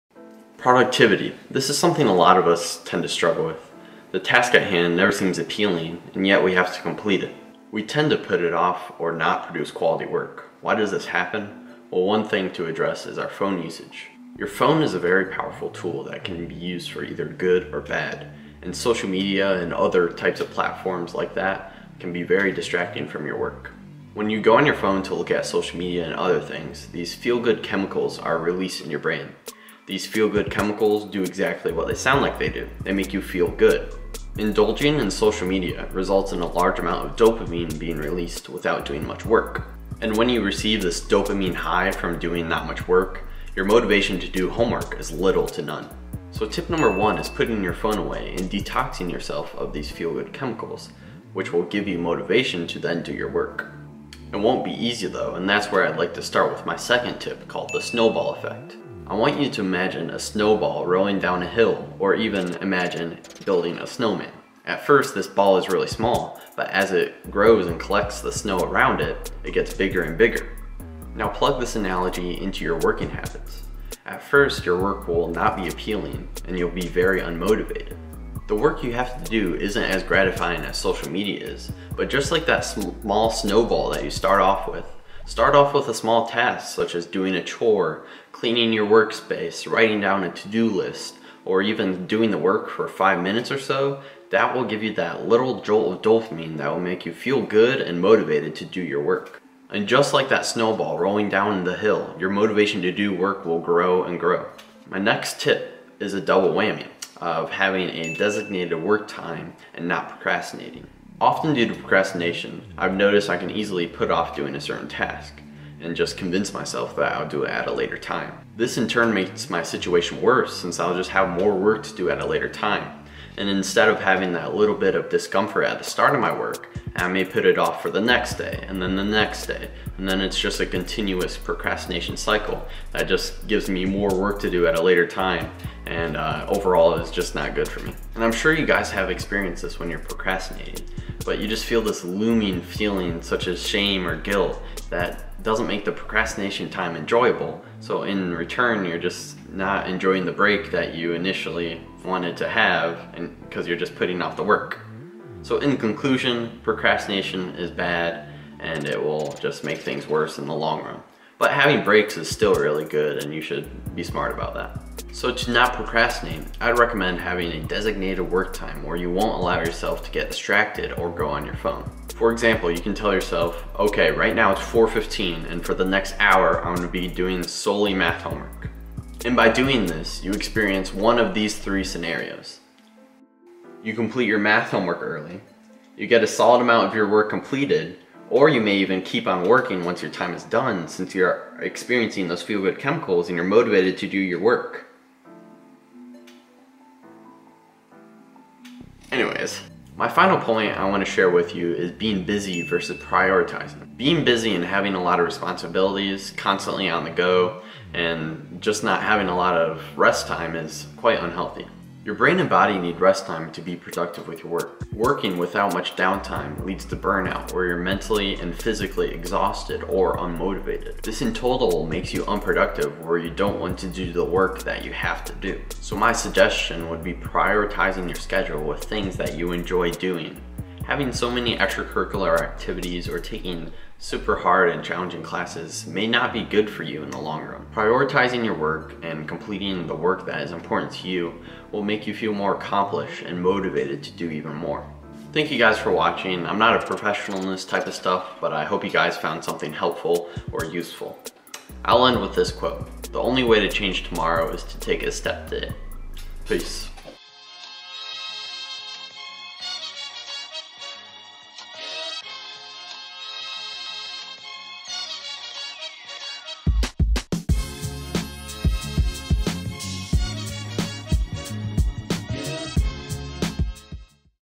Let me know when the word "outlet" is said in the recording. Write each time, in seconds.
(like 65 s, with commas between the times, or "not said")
not said.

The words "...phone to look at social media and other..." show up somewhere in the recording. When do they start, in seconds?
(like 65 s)
24 s.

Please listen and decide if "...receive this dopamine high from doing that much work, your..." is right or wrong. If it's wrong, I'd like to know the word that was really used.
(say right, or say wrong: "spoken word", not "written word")
right.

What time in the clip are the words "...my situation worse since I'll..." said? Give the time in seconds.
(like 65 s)
119 s.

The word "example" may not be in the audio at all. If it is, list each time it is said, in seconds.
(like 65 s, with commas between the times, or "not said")
172 s.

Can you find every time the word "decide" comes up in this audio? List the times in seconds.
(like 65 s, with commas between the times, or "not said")
not said.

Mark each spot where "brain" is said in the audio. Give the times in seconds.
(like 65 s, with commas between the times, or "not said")
28 s, 212 s.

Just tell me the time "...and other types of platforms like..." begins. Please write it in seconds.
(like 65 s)
19 s.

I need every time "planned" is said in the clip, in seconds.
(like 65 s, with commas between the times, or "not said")
not said.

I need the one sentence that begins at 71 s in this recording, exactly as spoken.
Now plug this analogy into your working habits.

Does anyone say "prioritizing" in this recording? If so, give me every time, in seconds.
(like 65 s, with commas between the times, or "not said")
203 s, 227 s, 237 s.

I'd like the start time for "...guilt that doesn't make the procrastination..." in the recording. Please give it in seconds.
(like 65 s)
144 s.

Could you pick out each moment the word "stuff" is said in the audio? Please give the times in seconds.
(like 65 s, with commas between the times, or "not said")
247 s.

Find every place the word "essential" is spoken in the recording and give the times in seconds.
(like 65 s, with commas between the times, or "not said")
not said.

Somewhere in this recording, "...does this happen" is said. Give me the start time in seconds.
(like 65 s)
10 s.